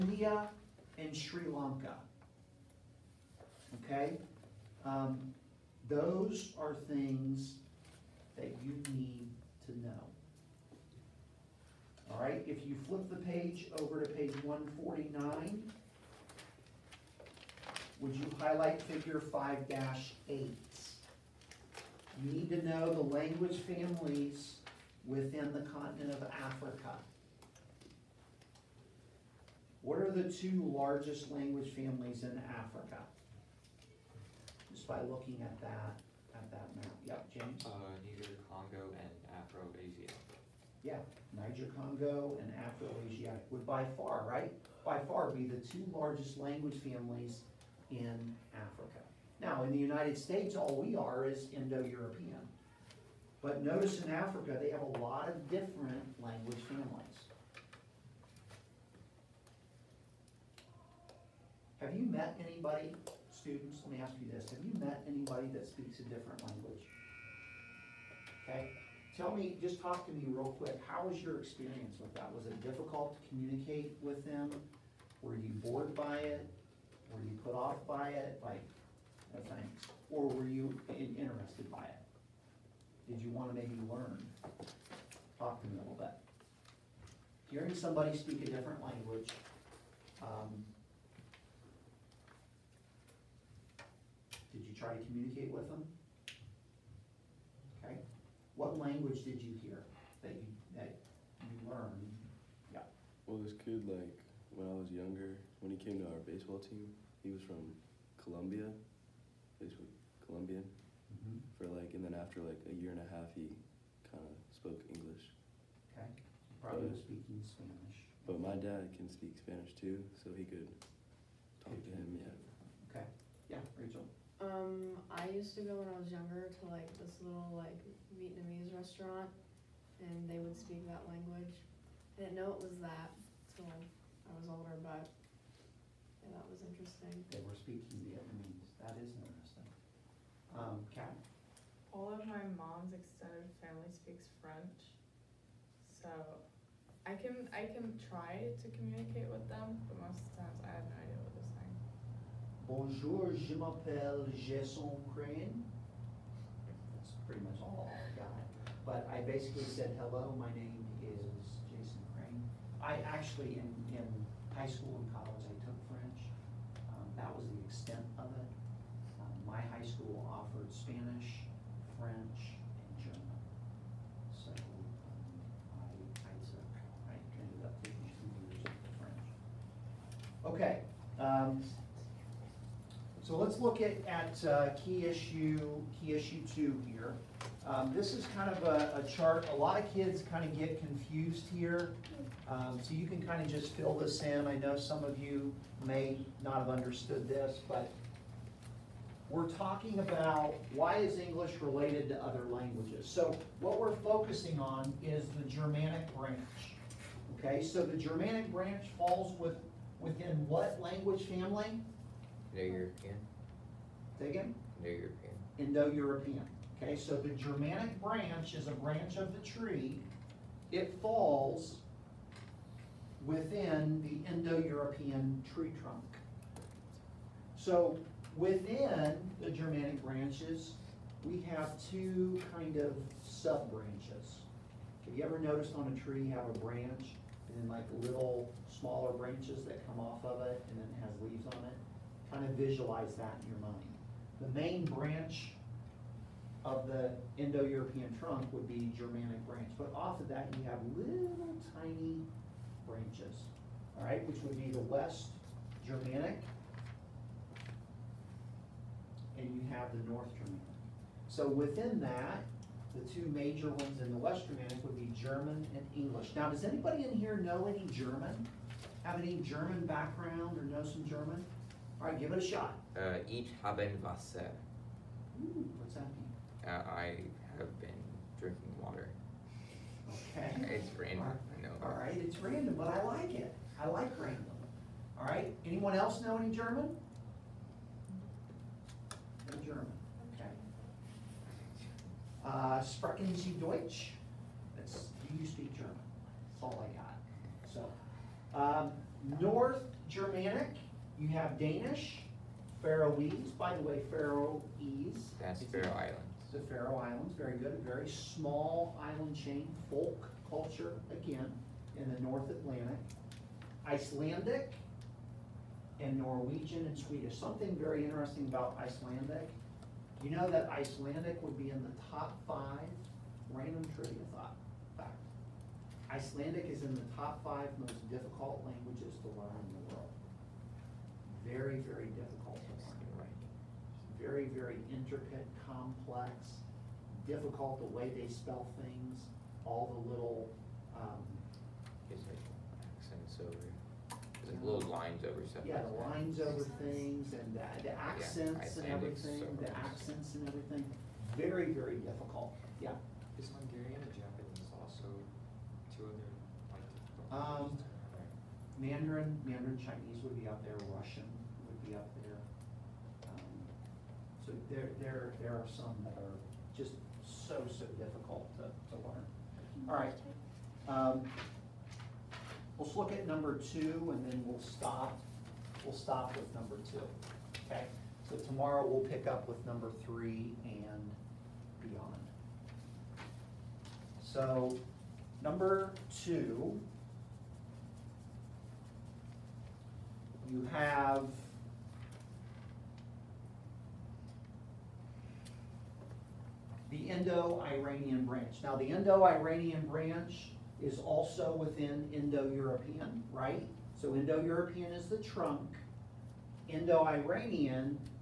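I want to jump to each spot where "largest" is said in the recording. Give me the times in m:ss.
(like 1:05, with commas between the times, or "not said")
0:30, 0:45.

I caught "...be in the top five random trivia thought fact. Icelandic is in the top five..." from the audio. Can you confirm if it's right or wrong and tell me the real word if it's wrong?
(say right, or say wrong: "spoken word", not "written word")
right.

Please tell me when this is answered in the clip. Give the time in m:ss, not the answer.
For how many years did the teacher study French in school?
2:58.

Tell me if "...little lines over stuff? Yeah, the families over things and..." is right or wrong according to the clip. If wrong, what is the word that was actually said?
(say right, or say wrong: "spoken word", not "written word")
wrong: "lines", not "families".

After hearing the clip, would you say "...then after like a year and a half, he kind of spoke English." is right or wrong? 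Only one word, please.
right.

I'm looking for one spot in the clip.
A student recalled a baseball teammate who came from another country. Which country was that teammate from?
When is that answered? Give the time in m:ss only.
1:48.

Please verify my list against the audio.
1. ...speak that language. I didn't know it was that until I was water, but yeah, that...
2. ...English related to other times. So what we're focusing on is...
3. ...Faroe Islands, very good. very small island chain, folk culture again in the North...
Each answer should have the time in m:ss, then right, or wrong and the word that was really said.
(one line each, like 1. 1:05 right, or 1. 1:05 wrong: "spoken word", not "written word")
1. 2:10 wrong: "older", not "water"
2. 3:21 wrong: "languages", not "times"
3. 5:06 right.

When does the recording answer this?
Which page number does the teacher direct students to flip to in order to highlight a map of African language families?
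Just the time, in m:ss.
0:14.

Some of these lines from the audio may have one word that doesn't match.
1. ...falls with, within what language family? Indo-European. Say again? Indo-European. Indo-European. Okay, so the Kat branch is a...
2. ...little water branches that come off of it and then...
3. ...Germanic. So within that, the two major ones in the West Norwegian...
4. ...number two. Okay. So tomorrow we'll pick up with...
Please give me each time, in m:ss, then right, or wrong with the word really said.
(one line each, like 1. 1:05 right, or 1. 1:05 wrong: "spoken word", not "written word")
1. 3:28 wrong: "Germanic", not "Kat"
2. 3:57 wrong: "smaller", not "water"
3. 4:20 wrong: "Germanic", not "Norwegian"
4. 6:16 right.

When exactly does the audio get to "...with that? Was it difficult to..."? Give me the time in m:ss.
1:11.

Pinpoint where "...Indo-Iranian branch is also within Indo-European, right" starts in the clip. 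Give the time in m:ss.
6:38.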